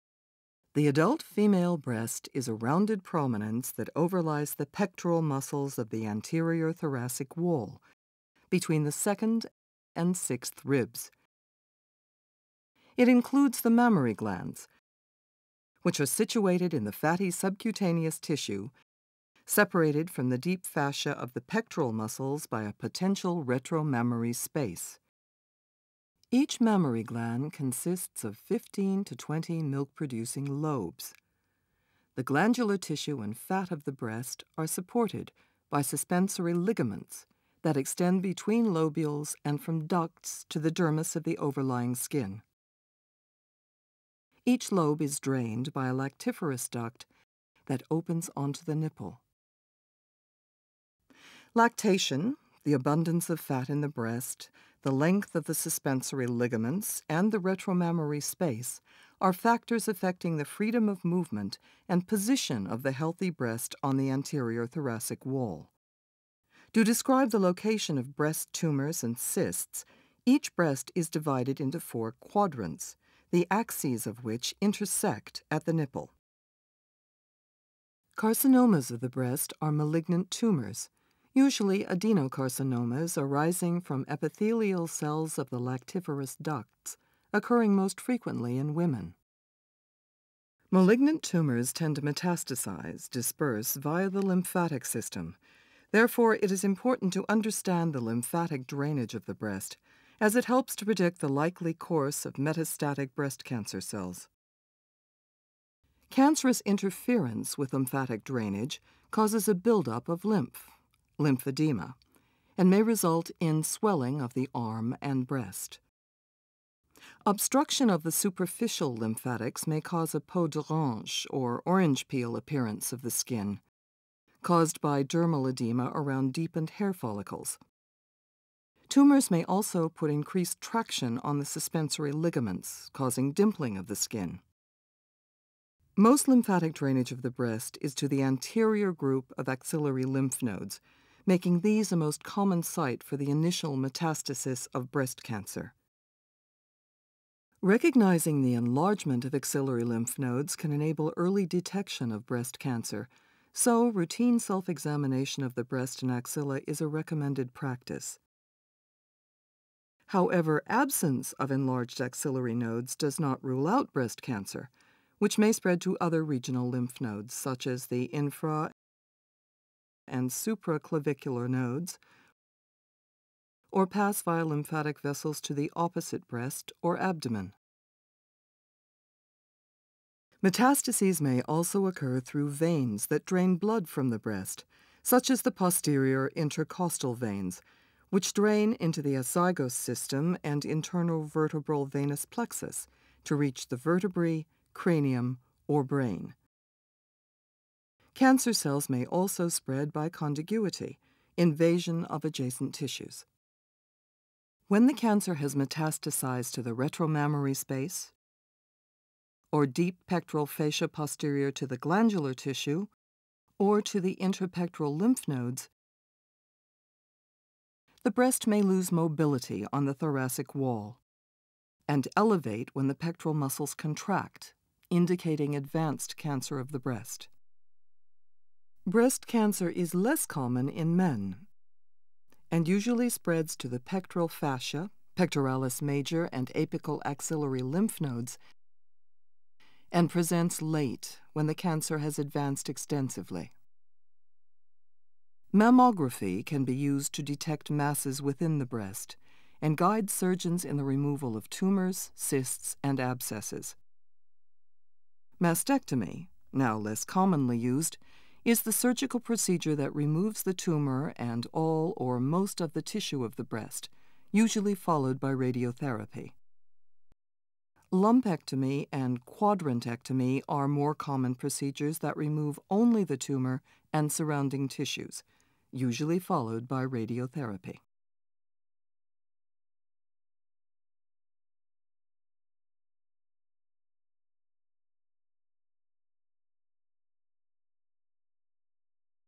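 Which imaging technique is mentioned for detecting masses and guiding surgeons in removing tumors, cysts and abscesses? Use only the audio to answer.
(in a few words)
Mammography.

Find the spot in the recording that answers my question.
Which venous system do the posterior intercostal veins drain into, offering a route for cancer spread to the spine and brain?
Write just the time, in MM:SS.
03:09.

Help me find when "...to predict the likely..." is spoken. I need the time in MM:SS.
01:40.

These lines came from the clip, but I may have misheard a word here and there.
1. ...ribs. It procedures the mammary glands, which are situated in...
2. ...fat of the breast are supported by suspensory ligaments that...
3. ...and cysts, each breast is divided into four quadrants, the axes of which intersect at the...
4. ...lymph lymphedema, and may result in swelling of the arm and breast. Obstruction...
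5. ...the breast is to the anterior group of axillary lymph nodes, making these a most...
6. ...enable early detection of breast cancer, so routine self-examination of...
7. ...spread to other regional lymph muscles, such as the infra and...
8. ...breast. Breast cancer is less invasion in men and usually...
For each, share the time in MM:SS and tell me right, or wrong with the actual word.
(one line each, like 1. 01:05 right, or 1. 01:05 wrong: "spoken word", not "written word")
1. 00:10 wrong: "includes", not "procedures"
2. 00:33 right
3. 01:09 right
4. 01:50 right
5. 02:17 right
6. 02:30 right
7. 02:45 wrong: "nodes", not "muscles"
8. 03:46 wrong: "common", not "invasion".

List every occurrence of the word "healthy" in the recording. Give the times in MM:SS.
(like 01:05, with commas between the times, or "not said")
01:02.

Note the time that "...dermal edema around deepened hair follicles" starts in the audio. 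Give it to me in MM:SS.
02:05.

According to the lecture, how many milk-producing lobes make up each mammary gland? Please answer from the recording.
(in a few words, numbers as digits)
15 to 20.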